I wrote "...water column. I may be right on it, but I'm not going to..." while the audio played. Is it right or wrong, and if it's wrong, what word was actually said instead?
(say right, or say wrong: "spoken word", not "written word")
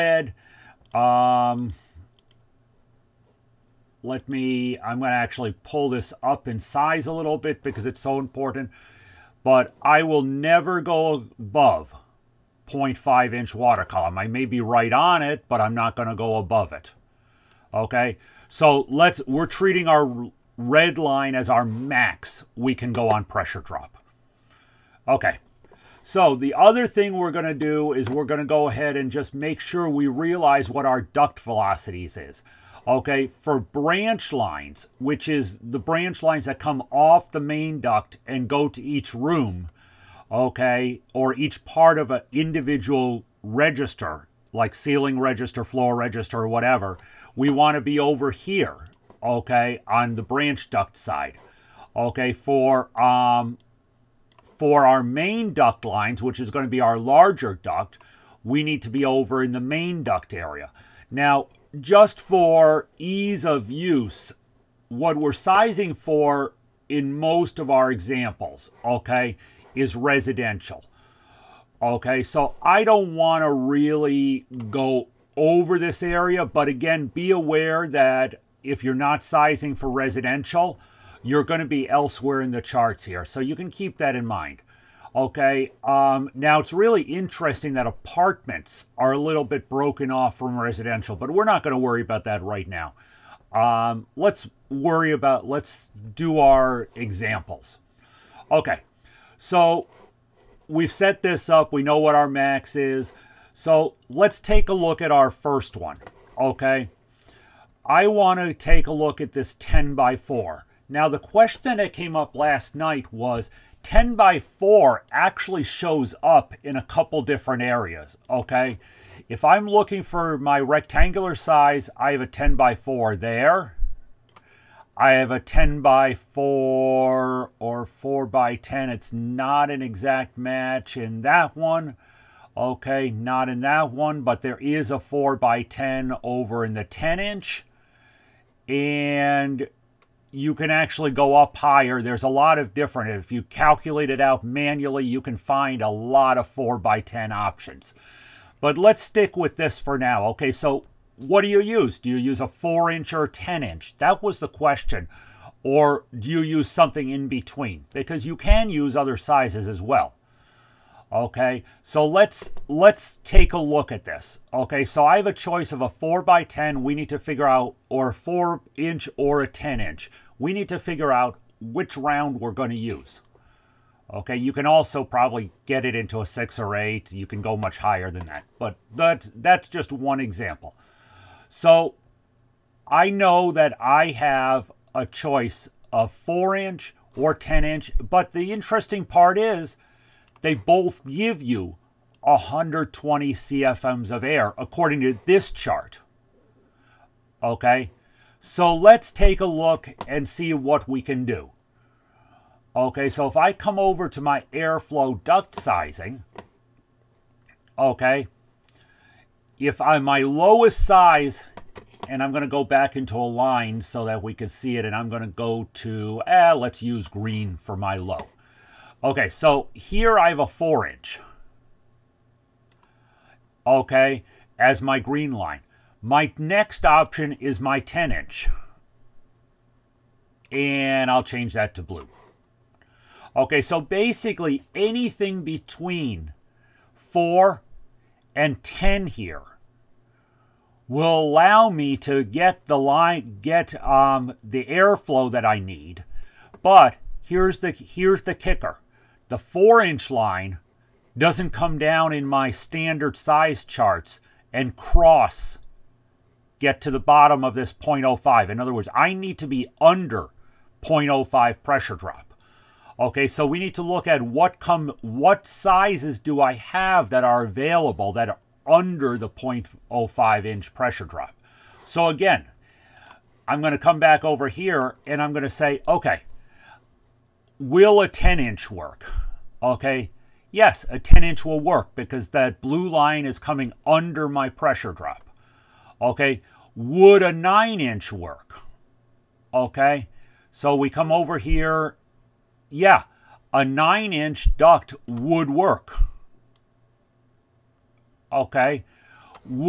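right.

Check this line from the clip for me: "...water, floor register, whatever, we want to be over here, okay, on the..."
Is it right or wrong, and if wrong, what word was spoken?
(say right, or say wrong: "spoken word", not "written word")
wrong: "register", not "water".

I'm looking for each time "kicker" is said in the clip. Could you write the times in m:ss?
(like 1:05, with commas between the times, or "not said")
4:08.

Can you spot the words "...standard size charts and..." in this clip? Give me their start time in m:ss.
4:12.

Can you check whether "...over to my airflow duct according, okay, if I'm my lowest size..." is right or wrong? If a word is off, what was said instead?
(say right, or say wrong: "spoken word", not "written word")
wrong: "sizing", not "according".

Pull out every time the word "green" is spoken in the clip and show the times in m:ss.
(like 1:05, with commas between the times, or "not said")
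3:37, 3:44.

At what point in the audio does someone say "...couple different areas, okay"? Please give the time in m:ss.
1:56.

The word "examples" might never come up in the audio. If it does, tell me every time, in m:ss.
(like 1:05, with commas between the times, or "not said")
1:07, 1:36, 3:00.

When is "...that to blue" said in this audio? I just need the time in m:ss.
3:51.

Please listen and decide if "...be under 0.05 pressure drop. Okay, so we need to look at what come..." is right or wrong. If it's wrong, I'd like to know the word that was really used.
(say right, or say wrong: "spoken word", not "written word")
right.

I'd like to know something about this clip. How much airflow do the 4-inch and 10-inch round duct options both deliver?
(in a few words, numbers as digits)
120 CFM.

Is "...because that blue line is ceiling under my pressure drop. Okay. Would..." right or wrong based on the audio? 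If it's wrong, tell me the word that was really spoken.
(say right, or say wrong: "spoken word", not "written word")
wrong: "coming", not "ceiling".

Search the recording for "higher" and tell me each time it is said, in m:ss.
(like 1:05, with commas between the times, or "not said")
2:21, 2:57.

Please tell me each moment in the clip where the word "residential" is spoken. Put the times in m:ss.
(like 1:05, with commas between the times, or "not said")
1:09, 1:19, 1:30.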